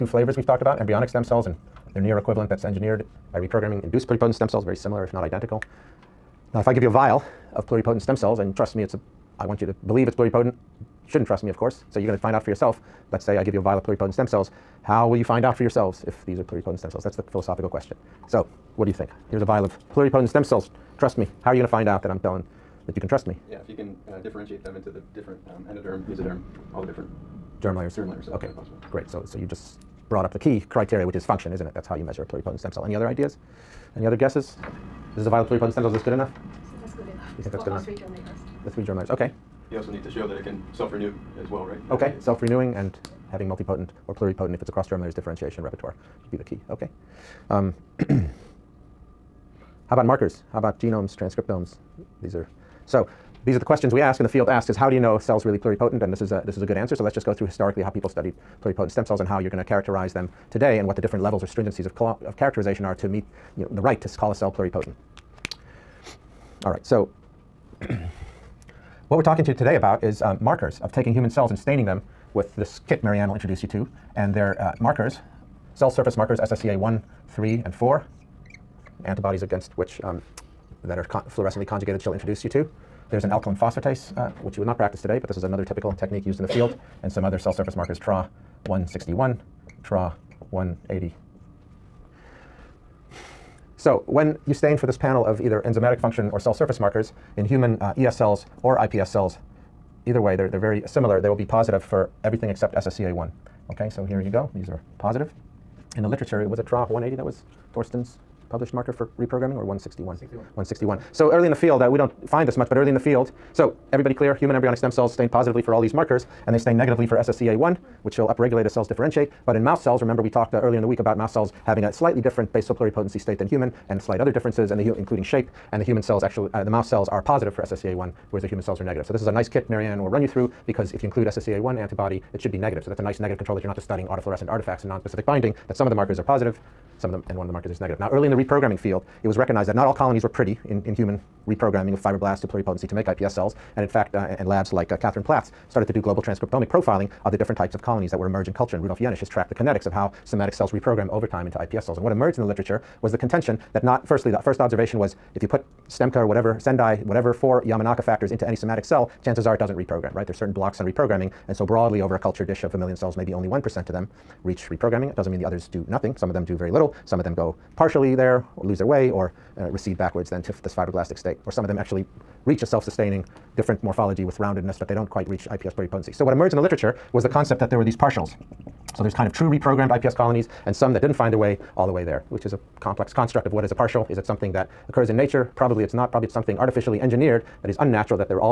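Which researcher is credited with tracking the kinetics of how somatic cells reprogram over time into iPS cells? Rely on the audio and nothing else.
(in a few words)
Rudolf Jaenisch.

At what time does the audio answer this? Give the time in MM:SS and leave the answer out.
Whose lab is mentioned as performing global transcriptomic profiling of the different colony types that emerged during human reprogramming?
02:24.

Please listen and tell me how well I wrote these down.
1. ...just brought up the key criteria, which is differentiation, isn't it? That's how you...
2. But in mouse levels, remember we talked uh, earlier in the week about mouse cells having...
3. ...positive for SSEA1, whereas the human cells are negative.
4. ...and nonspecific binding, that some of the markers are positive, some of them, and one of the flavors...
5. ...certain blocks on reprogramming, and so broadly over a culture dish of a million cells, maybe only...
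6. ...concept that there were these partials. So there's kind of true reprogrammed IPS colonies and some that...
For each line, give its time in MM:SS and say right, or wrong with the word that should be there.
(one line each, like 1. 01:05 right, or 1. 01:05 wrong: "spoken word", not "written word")
1. 00:29 wrong: "function", not "differentiation"
2. 01:59 wrong: "cells", not "levels"
3. 02:07 right
4. 02:14 wrong: "markers", not "flavors"
5. 02:40 right
6. 02:57 right.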